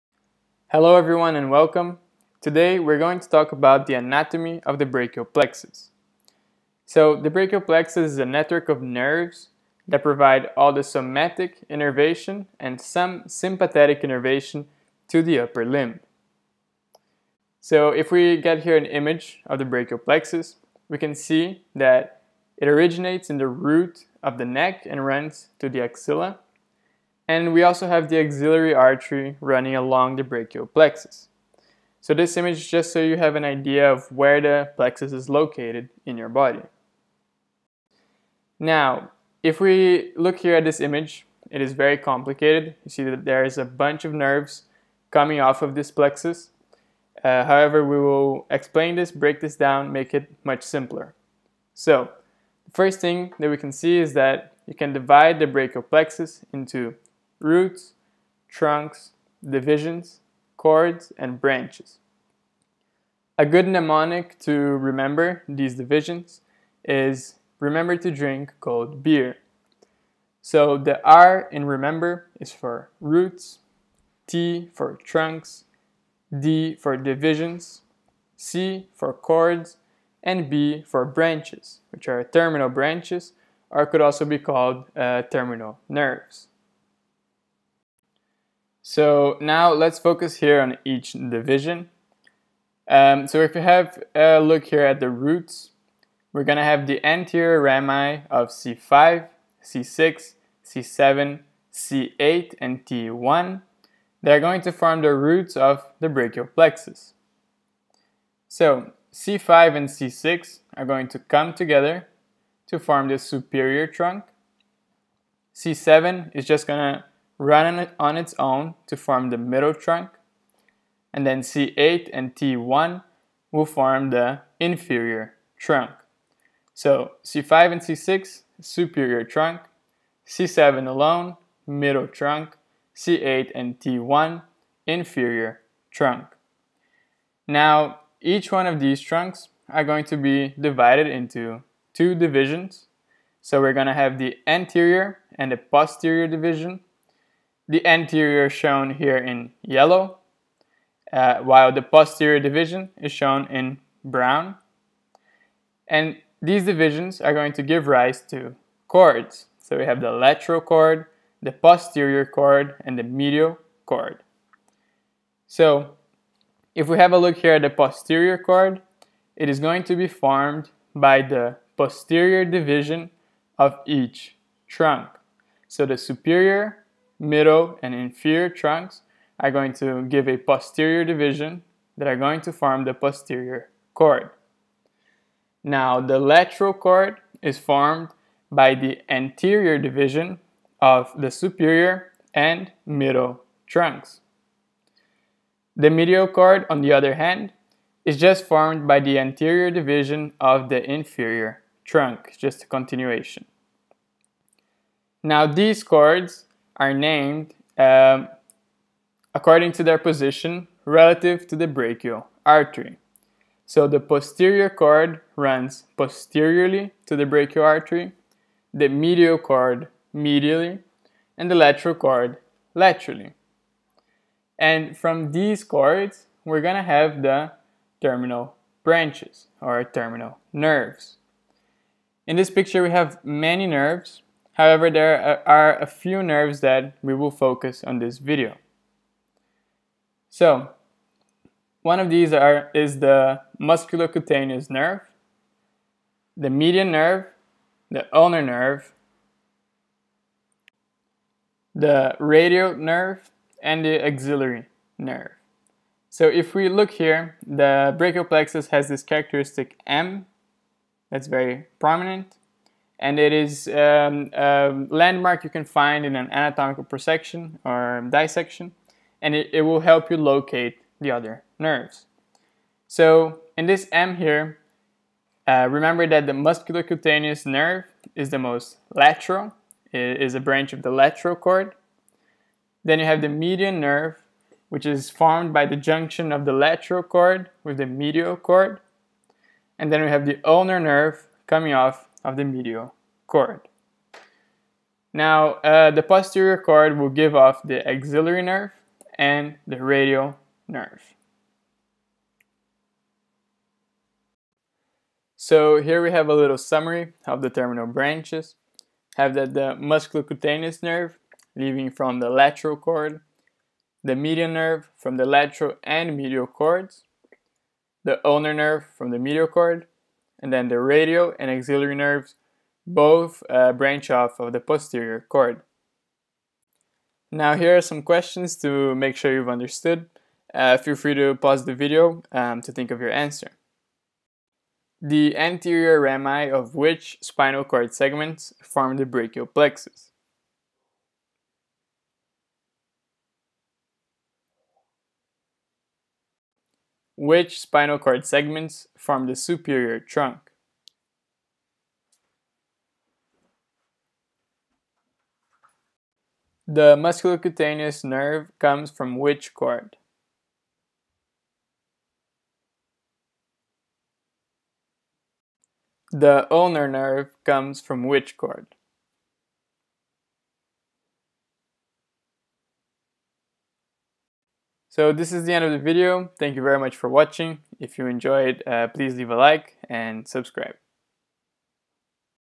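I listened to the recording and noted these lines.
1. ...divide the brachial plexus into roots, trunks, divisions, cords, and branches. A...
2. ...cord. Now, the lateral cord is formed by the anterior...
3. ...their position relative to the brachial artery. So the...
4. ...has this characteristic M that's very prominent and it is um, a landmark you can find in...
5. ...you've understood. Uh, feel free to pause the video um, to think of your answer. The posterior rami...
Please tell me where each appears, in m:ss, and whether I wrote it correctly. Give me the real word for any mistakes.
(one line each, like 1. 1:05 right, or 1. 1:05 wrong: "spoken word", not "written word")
1. 0:54 right
2. 3:03 right
3. 3:29 right
4. 4:18 right
5. 5:29 wrong: "anterior", not "posterior".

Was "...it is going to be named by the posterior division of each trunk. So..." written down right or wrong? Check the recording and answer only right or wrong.
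wrong.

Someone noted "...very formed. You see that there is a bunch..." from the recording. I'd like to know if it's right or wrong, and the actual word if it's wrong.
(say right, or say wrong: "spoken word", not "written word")
wrong: "complicated", not "formed".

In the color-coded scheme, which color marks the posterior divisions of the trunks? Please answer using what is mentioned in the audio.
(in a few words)
Brown.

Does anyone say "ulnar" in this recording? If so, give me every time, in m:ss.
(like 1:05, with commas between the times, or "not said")
4:08, 4:50, 5:18, 6:06.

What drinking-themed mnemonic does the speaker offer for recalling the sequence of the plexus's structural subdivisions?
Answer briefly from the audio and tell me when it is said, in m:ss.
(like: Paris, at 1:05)
Remember to drink cold beer, at 1:07.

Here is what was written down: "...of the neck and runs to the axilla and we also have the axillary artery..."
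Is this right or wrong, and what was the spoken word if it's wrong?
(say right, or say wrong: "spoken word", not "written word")
right.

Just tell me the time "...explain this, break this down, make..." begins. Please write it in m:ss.
0:48.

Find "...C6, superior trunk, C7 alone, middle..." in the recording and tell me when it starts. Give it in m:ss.
2:07.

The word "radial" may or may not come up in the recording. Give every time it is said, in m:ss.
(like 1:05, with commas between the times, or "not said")
4:12, 4:59, 5:20.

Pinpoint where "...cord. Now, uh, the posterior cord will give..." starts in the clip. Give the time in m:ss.
4:53.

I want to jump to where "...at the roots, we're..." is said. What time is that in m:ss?
1:34.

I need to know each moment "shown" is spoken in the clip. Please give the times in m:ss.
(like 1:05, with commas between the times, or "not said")
2:28, 2:33.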